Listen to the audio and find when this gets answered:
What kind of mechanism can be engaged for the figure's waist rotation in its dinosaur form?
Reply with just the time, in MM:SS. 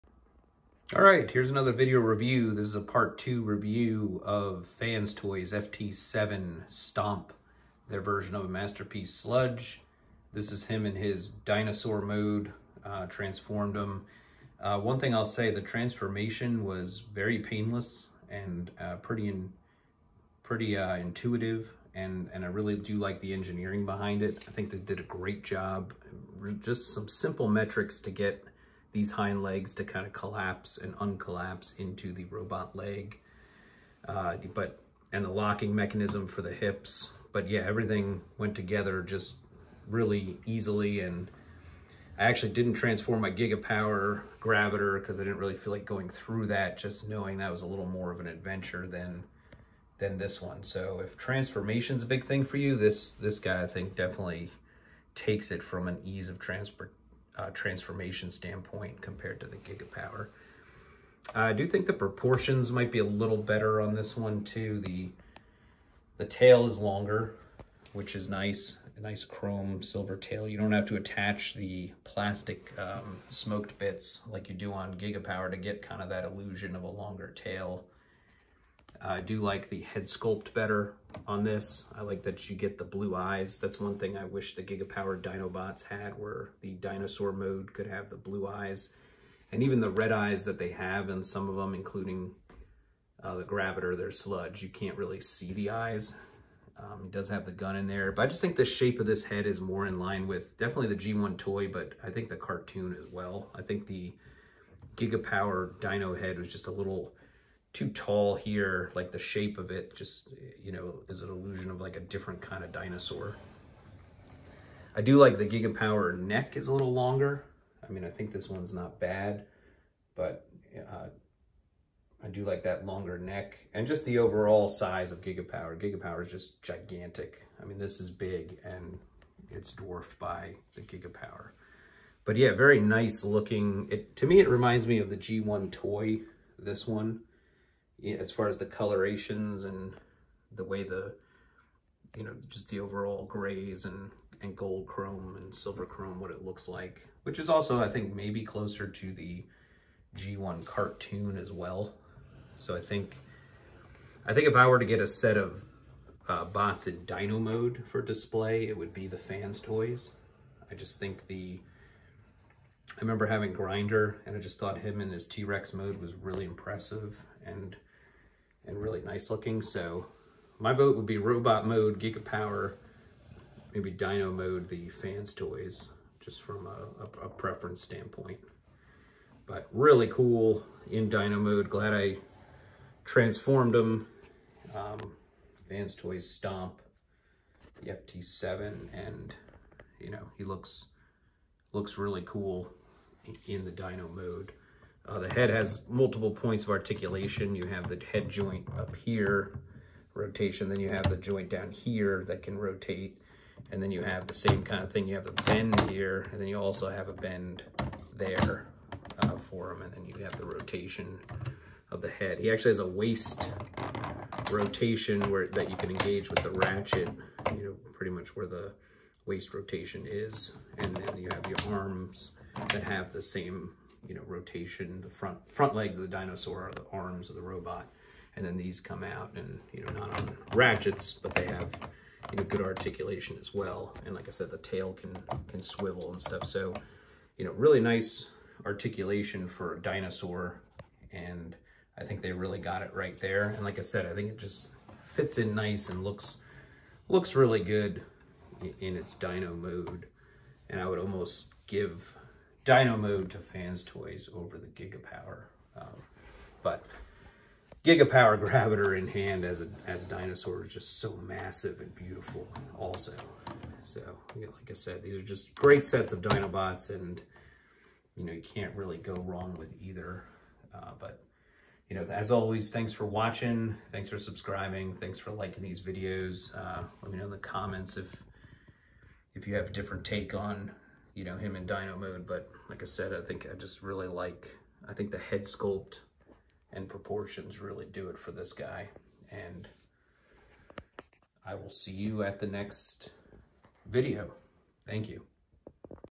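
03:36.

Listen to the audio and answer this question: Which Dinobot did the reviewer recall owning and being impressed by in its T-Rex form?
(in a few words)
Grinder.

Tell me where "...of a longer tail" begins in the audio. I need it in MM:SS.
01:16.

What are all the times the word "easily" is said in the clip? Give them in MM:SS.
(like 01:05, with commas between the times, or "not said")
00:40.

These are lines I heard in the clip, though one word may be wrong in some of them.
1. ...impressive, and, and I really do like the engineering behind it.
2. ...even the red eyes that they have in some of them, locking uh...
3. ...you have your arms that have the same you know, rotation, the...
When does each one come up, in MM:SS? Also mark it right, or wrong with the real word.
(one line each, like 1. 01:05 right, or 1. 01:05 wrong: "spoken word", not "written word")
1. 00:20 wrong: "intuitive", not "impressive"
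2. 01:29 wrong: "including", not "locking"
3. 03:41 right.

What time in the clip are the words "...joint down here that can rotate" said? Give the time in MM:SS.
03:21.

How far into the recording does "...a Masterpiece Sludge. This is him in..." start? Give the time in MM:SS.
00:08.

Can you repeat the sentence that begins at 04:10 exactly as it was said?
And I would almost give dino mode to fans toys over the Gigapower.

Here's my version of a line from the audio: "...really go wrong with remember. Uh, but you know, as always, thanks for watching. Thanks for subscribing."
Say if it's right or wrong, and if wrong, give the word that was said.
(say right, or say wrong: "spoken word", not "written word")
wrong: "either", not "remember".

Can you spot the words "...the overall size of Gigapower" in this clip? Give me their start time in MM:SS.
02:04.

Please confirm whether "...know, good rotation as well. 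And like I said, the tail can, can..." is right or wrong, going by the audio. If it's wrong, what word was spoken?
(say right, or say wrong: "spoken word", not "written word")
wrong: "articulation", not "rotation".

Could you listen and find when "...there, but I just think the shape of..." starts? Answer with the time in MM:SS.
01:37.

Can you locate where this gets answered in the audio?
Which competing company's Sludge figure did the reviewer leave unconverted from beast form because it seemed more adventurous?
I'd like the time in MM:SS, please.
00:43.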